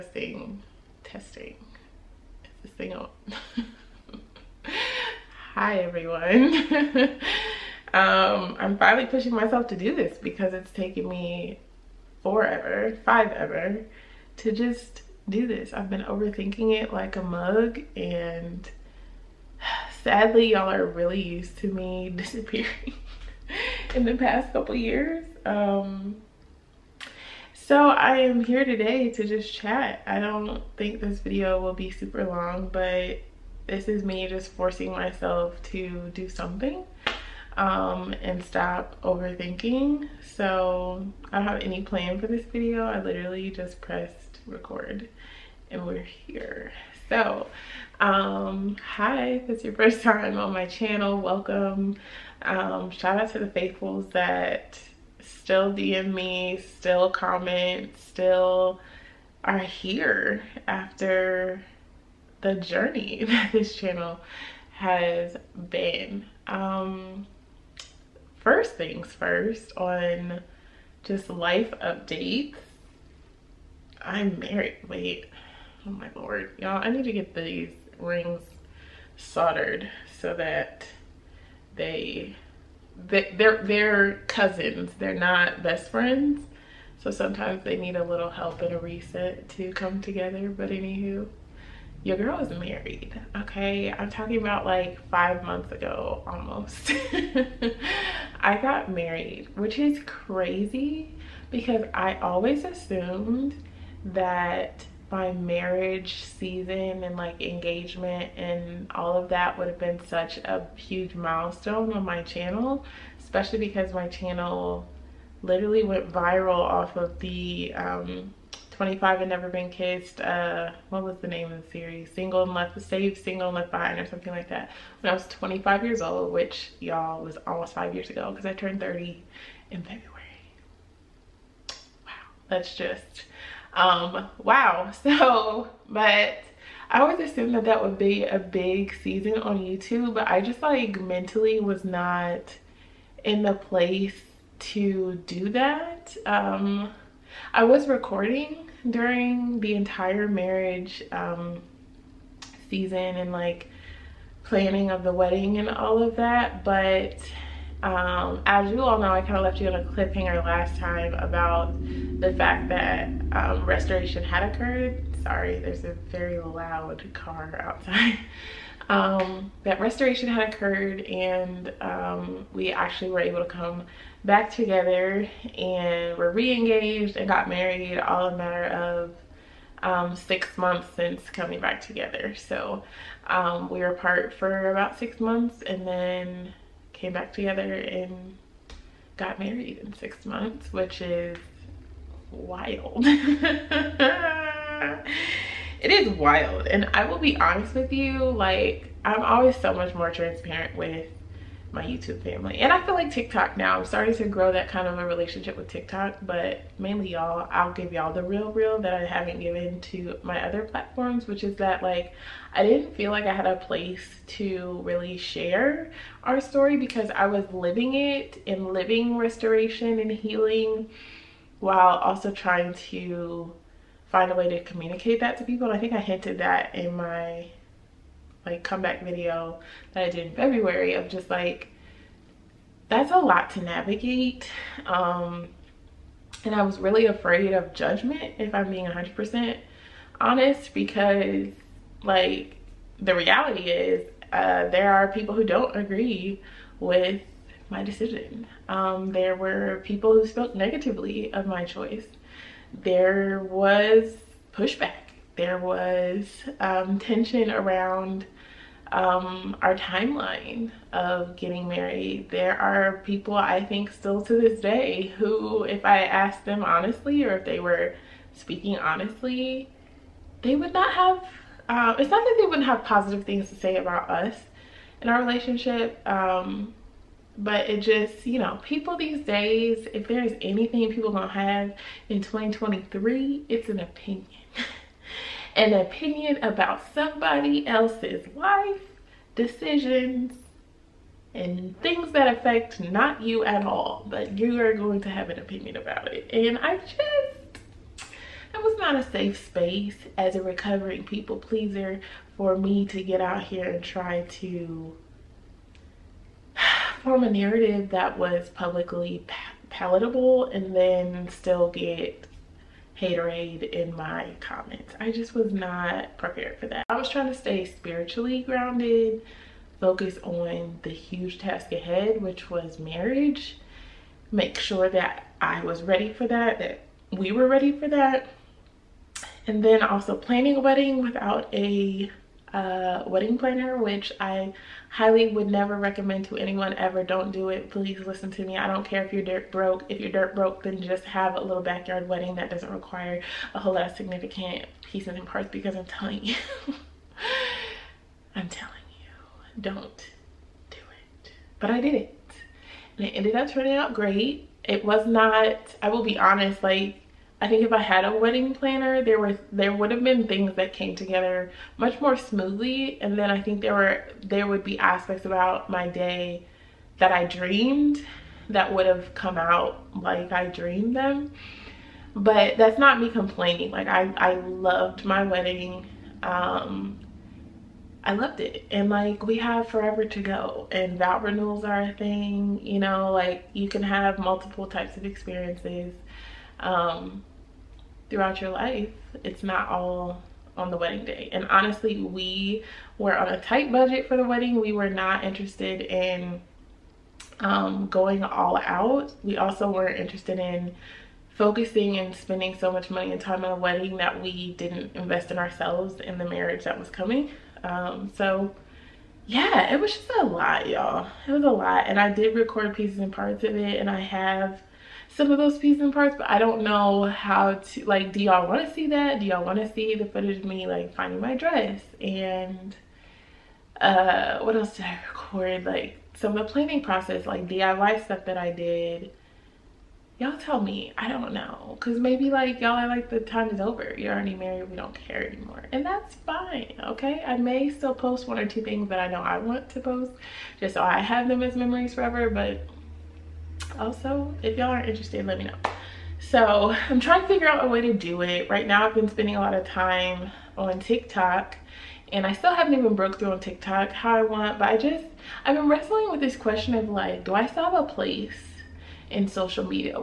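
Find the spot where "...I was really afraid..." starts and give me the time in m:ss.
3:56.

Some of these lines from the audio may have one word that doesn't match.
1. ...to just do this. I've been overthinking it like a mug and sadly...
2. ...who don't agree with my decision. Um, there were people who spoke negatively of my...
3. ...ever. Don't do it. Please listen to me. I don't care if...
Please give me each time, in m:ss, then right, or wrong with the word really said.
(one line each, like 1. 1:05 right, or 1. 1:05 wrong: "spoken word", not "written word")
1. 0:14 right
2. 4:05 right
3. 5:36 right.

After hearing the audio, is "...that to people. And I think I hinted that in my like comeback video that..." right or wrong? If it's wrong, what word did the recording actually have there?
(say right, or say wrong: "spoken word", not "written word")
right.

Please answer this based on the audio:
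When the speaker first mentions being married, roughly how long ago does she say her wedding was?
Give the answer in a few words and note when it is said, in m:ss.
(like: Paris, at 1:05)
5 months, at 1:35.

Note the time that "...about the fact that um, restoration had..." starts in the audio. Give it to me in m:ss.
2:41.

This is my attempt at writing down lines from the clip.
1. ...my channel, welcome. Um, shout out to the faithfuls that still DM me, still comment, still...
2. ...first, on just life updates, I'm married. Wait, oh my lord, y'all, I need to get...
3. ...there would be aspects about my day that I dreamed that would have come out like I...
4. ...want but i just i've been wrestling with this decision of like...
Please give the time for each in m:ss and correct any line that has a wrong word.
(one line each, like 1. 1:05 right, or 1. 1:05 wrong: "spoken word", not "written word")
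1. 0:50 right
2. 1:09 right
3. 6:04 right
4. 7:34 wrong: "question", not "decision".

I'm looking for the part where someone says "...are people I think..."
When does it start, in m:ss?
4:22.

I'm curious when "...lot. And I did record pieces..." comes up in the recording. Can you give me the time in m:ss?
6:51.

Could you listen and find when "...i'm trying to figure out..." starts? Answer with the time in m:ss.
7:26.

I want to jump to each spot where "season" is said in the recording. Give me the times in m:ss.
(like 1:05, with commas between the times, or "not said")
1:46, 2:19, 2:32.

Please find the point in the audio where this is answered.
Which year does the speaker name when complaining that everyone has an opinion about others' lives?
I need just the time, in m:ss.
4:42.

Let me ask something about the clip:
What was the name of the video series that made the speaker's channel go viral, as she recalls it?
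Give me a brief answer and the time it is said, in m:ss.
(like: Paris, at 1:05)
Single and Left Behind, at 2:03.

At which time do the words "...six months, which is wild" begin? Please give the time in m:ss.
3:09.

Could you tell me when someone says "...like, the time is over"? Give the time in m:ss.
7:12.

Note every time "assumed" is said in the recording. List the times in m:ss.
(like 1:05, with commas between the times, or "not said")
1:42, 2:17.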